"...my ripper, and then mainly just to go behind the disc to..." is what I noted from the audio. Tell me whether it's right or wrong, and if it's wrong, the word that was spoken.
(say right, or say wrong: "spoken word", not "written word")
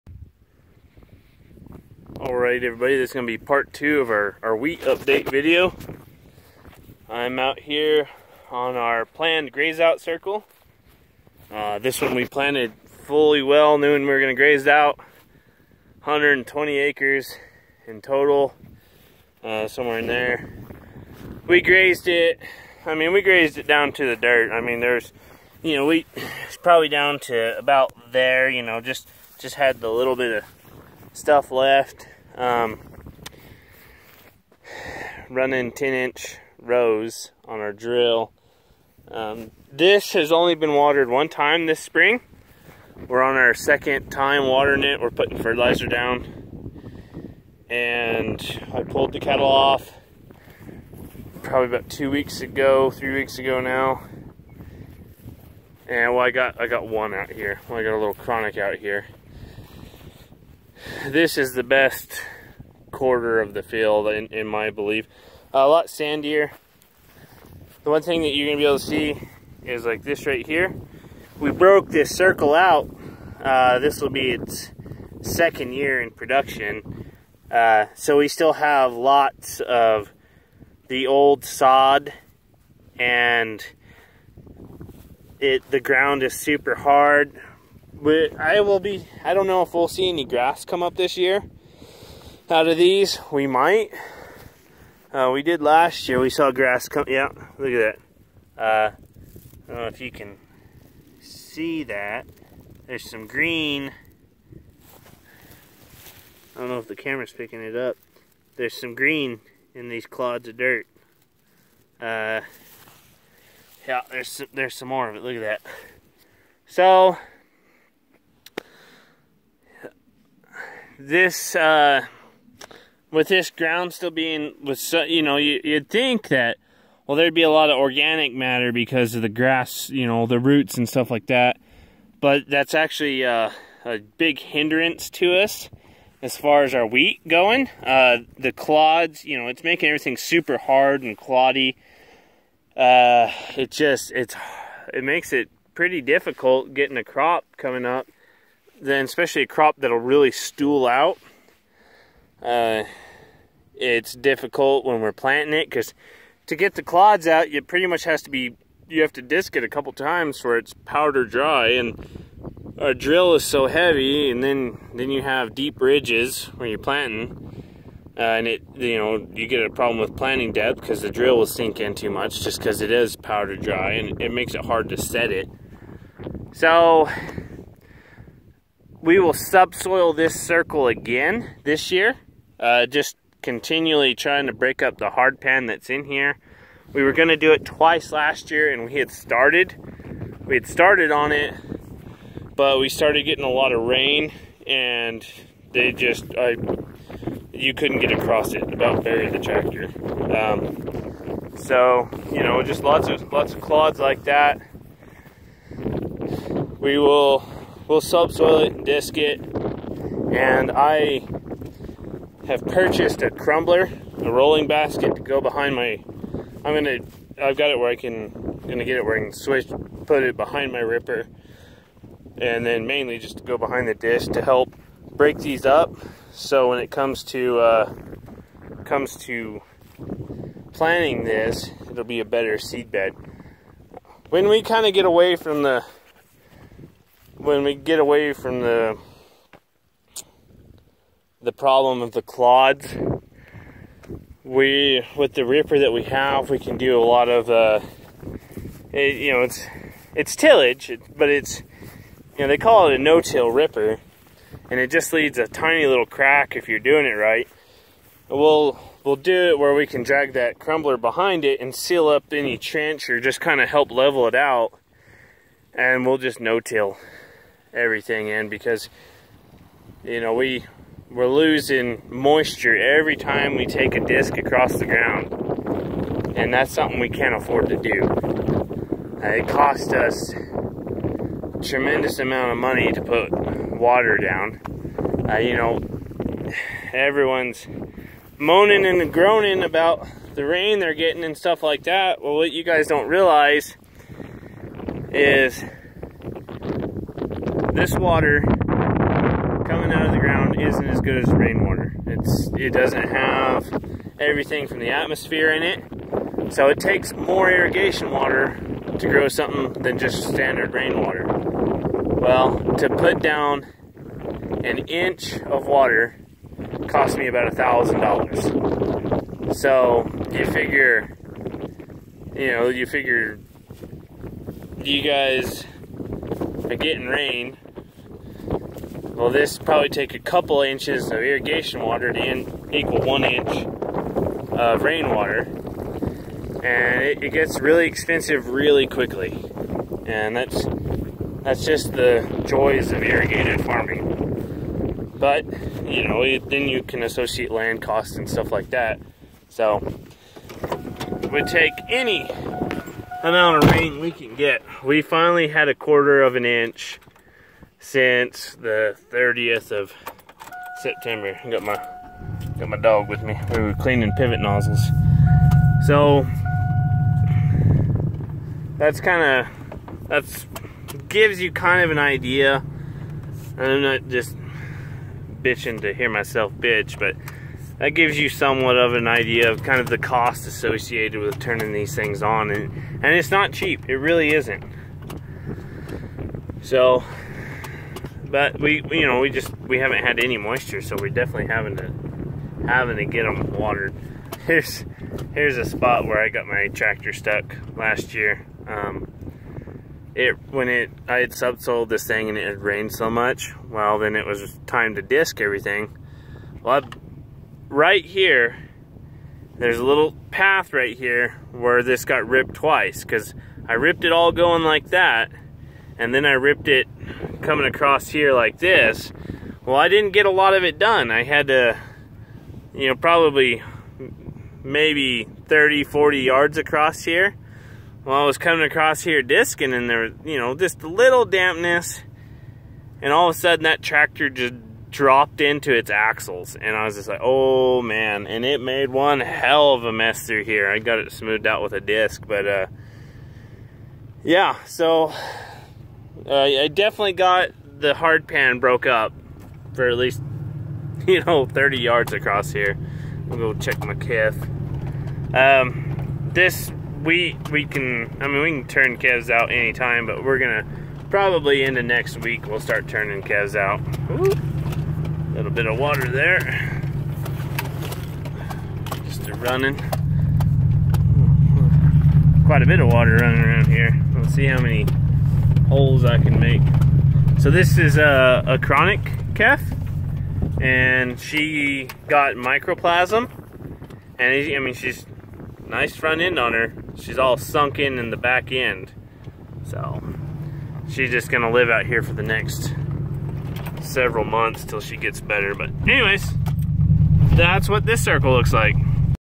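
right.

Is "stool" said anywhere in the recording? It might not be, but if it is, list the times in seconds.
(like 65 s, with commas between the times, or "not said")
150 s.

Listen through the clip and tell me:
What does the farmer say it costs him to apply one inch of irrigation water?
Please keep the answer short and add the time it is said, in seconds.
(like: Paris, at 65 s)
$1,000, at 317 s.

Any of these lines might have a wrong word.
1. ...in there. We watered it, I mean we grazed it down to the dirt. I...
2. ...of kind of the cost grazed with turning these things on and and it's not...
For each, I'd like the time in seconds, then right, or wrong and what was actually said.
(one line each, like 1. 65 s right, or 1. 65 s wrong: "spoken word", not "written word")
1. 19 s wrong: "grazed", not "watered"
2. 379 s wrong: "associated", not "grazed".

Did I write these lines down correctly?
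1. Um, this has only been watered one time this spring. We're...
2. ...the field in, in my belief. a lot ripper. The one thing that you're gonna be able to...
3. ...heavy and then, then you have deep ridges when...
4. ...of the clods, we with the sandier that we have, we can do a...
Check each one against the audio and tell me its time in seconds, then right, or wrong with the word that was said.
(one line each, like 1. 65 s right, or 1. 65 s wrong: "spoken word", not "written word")
1. 39 s right
2. 63 s wrong: "sandier", not "ripper"
3. 163 s right
4. 242 s wrong: "ripper", not "sandier".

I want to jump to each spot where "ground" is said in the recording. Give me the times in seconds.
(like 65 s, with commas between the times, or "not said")
85 s, 123 s, 274 s, 300 s.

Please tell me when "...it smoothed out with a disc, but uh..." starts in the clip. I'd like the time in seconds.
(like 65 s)
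440 s.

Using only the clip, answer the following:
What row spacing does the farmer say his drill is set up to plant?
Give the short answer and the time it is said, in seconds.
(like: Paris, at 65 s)
10 inch, at 35 s.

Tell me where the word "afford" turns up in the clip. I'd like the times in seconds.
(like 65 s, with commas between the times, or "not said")
277 s.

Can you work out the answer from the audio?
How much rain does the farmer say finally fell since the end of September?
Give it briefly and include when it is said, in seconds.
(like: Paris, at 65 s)
a quarter of an inch, at 355 s.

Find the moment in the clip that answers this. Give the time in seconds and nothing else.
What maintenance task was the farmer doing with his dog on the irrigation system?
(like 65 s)
363 s.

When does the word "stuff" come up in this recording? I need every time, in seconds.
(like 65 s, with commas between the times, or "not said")
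31 s, 130 s, 291 s, 348 s.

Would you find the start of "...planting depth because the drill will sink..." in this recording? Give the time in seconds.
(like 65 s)
170 s.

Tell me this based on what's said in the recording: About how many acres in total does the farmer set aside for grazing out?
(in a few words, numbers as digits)
120.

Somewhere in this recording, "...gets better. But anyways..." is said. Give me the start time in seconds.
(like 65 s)
494 s.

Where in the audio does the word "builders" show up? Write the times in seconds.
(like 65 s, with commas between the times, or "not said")
not said.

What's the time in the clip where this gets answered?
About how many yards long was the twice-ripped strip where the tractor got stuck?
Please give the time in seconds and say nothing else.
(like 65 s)
425 s.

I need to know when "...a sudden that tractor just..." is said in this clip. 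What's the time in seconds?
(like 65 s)
433 s.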